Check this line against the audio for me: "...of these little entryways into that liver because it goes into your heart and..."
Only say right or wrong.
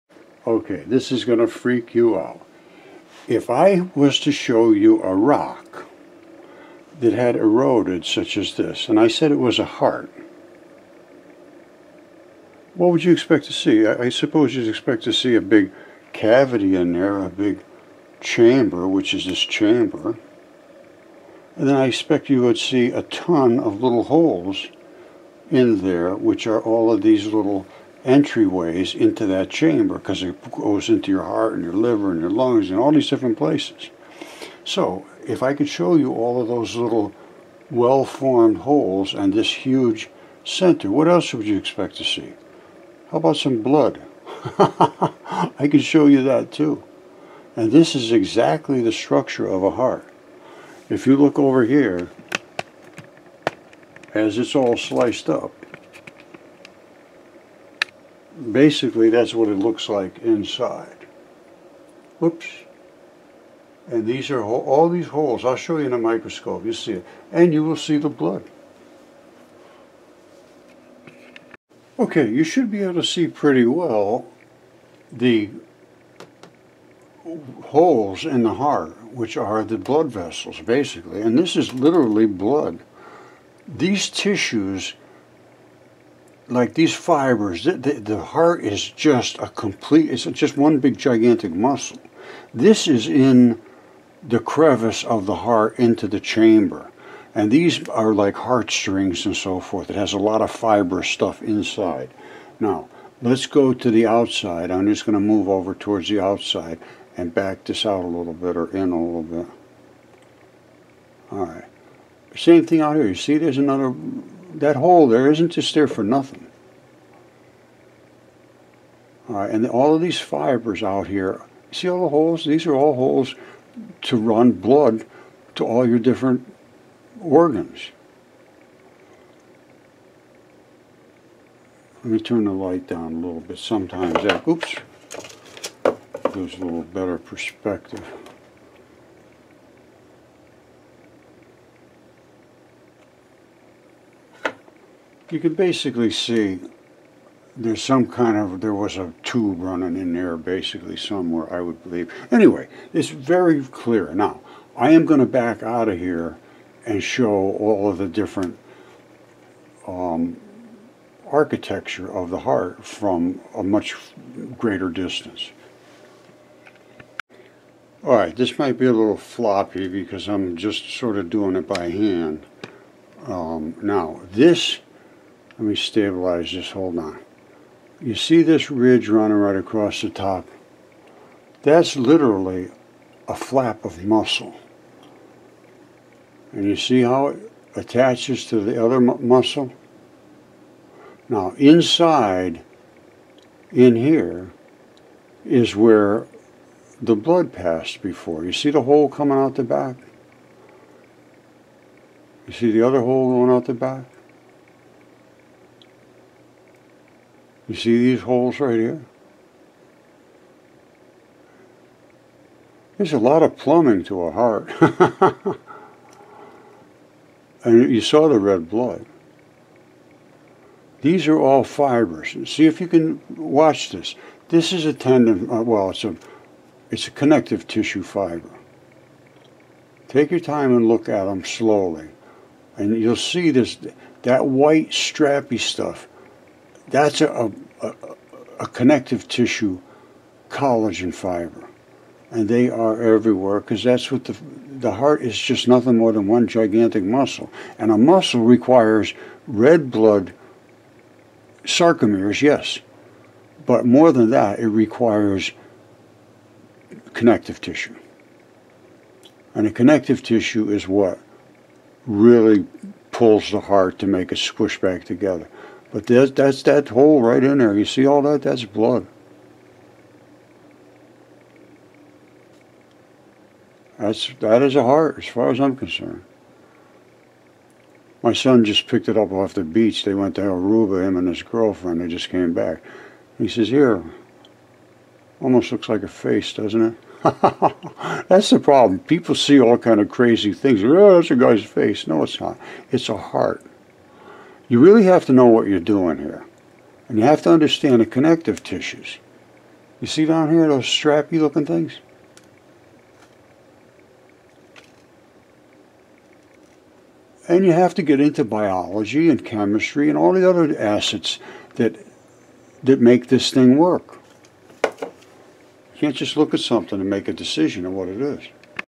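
wrong.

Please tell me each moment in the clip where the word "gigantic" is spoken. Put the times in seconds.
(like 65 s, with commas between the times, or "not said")
90 s, 246 s.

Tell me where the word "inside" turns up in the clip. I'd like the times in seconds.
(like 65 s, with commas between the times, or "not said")
60 s, 101 s, 191 s.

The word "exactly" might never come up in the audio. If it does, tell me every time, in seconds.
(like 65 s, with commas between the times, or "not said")
48 s.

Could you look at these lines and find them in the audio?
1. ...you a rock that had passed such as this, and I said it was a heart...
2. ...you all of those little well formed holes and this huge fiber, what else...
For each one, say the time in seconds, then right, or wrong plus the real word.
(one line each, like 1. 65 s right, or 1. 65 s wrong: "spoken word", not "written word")
1. 4 s wrong: "eroded", not "passed"
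2. 35 s wrong: "center", not "fiber".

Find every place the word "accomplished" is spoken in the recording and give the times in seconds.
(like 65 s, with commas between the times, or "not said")
not said.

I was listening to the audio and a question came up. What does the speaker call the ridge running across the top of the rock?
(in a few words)
a flap of muscle.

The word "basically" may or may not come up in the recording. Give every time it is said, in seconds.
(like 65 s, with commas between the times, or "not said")
58 s, 80 s, 145 s, 150 s.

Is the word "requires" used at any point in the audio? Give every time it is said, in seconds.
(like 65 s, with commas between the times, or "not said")
248 s, 254 s.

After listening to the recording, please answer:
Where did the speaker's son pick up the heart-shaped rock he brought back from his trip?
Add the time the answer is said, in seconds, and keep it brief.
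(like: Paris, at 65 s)
Aruba, at 280 s.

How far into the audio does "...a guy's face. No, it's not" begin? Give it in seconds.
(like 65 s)
291 s.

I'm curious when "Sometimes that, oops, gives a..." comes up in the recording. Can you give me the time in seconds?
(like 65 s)
133 s.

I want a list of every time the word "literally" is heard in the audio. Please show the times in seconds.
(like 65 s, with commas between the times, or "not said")
81 s, 181 s.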